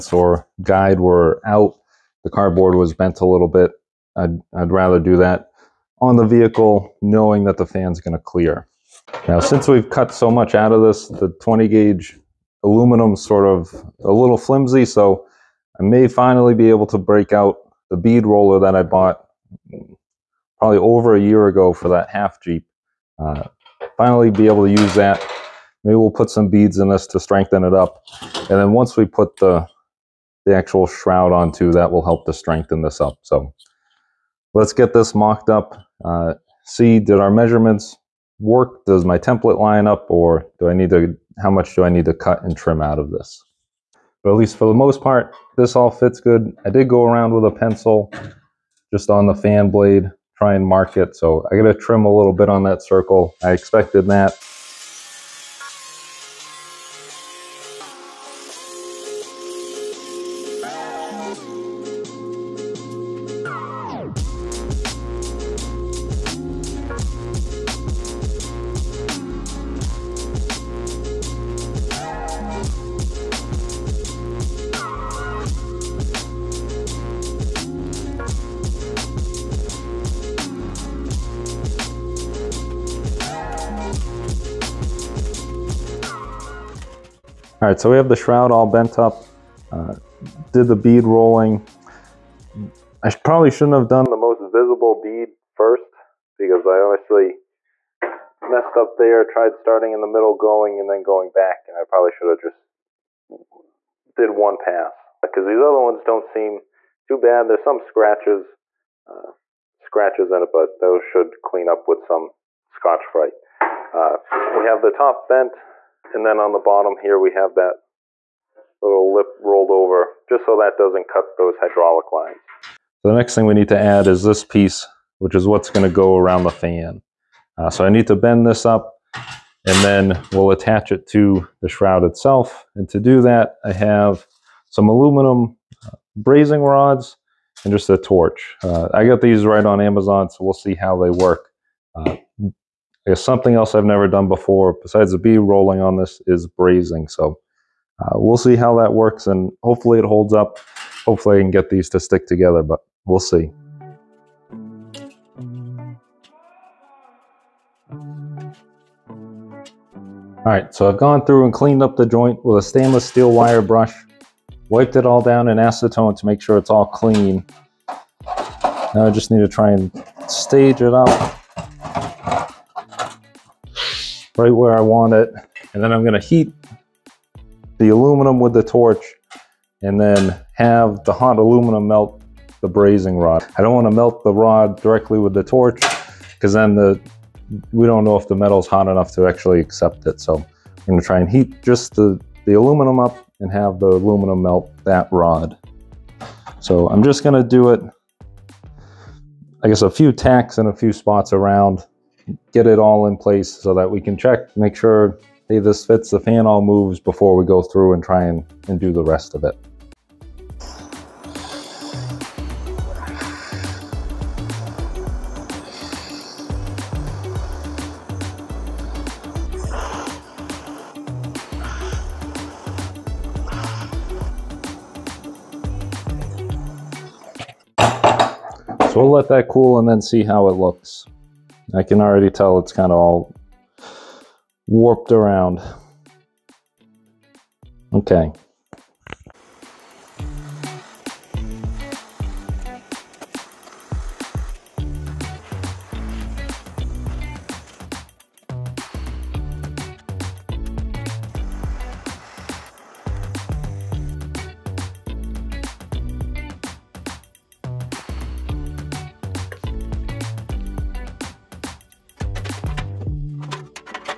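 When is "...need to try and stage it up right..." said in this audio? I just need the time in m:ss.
2:49.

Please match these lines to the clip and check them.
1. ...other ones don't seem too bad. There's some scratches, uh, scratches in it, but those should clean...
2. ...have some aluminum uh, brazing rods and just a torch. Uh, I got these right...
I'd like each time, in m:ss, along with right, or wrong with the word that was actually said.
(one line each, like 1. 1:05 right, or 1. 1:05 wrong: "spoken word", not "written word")
1. 1:45 right
2. 2:13 right.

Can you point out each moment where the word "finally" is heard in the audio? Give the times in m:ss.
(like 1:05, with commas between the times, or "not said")
0:16, 0:23.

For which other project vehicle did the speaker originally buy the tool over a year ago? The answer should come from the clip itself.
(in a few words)
half Jeep.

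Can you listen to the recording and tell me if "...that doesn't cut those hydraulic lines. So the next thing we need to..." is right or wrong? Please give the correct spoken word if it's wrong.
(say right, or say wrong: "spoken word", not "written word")
right.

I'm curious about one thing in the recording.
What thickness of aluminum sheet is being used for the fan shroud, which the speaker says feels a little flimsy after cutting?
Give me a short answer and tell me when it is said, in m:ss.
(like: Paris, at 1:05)
20 gauge, at 0:11.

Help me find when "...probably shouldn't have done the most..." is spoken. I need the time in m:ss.
1:33.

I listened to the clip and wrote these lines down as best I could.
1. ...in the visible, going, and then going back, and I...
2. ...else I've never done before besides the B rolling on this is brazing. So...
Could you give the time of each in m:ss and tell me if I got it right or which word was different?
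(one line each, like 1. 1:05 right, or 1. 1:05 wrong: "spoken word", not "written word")
1. 1:39 wrong: "middle", not "visible"
2. 2:23 right.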